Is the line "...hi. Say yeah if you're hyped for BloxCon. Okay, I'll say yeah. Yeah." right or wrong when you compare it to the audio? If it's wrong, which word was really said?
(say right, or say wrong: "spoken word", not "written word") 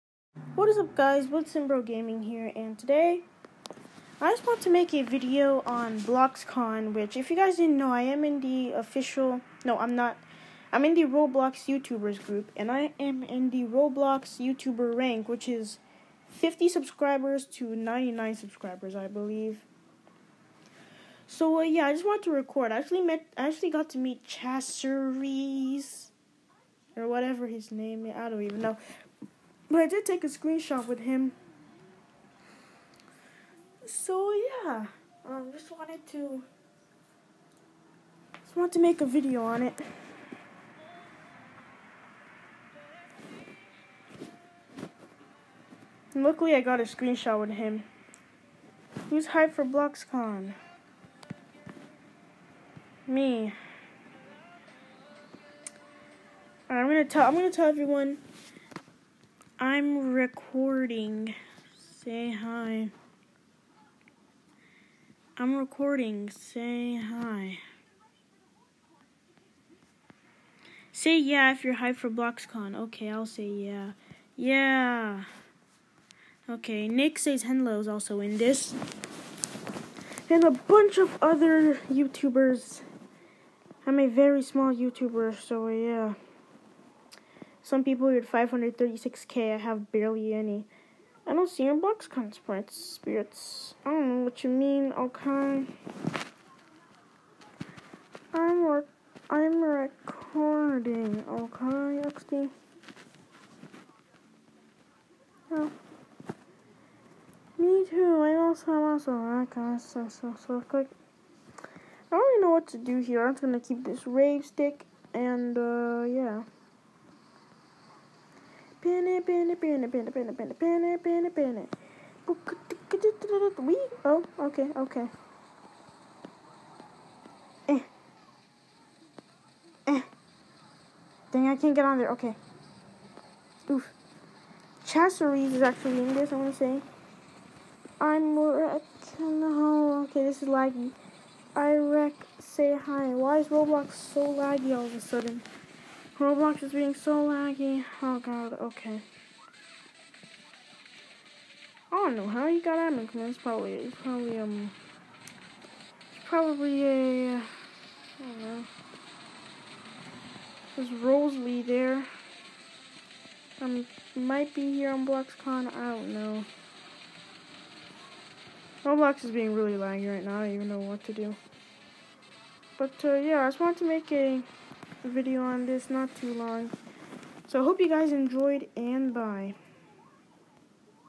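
right.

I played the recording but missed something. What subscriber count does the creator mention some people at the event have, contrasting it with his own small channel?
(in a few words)
536k.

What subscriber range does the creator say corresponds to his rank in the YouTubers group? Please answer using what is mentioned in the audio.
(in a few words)
50 to 99 subscribers.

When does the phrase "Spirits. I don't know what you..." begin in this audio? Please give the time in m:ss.
1:32.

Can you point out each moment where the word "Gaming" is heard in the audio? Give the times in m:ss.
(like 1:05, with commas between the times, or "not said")
0:01.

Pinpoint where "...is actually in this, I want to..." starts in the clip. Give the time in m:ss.
2:15.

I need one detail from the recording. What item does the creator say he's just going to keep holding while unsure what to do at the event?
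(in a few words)
rave stick.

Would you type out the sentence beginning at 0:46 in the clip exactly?
And luckily, I got a screenshot with him.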